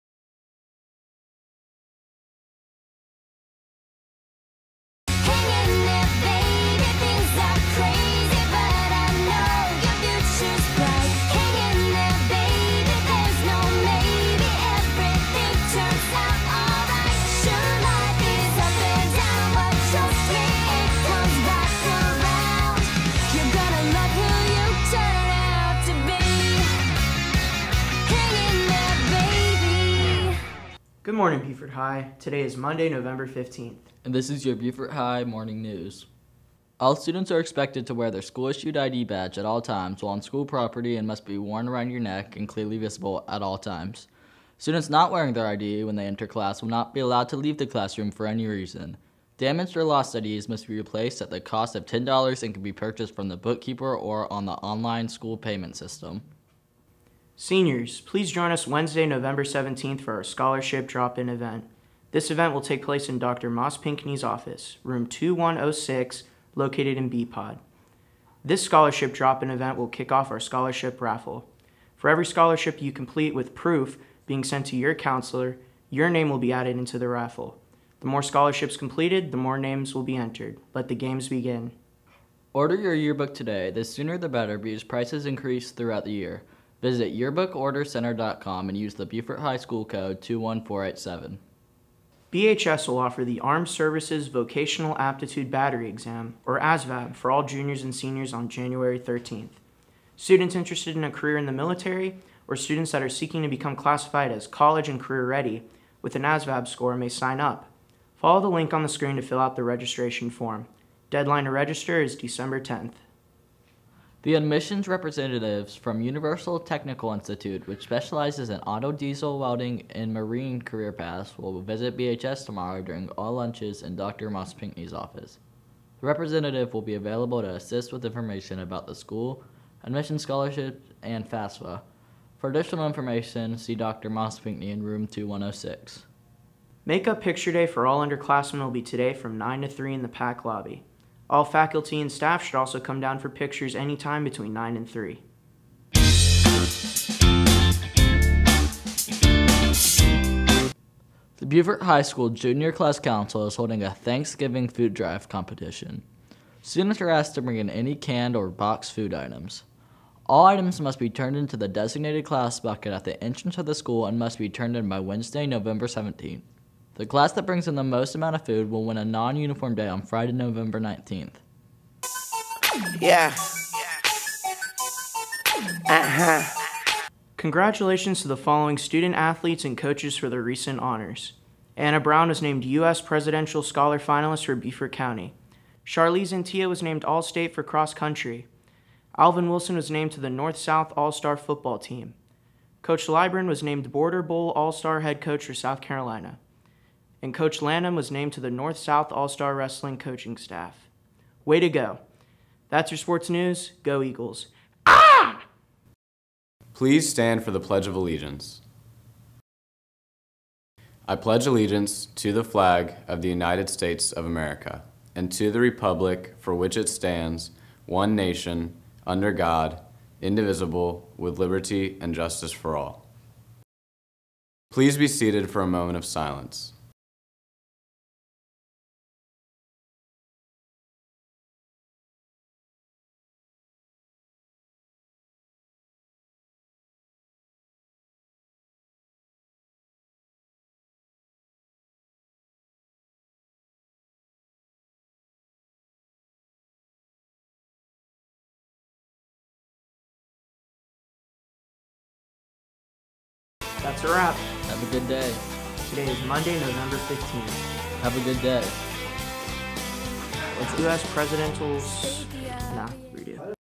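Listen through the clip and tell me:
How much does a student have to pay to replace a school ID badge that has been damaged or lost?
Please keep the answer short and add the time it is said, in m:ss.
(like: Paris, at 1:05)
$10, at 0:51.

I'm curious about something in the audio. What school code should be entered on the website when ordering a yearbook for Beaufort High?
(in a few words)
21487.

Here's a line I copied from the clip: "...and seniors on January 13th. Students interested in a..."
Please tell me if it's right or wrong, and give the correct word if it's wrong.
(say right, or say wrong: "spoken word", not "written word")
right.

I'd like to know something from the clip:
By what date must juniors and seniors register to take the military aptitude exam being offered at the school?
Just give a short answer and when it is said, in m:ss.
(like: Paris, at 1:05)
December 10th, at 1:52.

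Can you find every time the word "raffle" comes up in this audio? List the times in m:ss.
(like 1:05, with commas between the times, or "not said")
1:11, 1:17.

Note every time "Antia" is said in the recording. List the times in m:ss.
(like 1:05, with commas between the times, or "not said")
3:06.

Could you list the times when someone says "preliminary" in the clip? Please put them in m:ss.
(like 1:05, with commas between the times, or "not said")
not said.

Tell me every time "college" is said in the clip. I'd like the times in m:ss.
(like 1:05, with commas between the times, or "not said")
1:44.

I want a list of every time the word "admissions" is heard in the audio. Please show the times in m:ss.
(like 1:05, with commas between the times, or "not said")
1:54, 2:09.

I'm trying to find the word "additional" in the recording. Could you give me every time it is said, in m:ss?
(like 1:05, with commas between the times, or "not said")
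2:12.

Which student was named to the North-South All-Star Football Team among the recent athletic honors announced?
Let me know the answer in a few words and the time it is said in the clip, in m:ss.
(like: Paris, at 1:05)
Alvin Wilson, at 3:09.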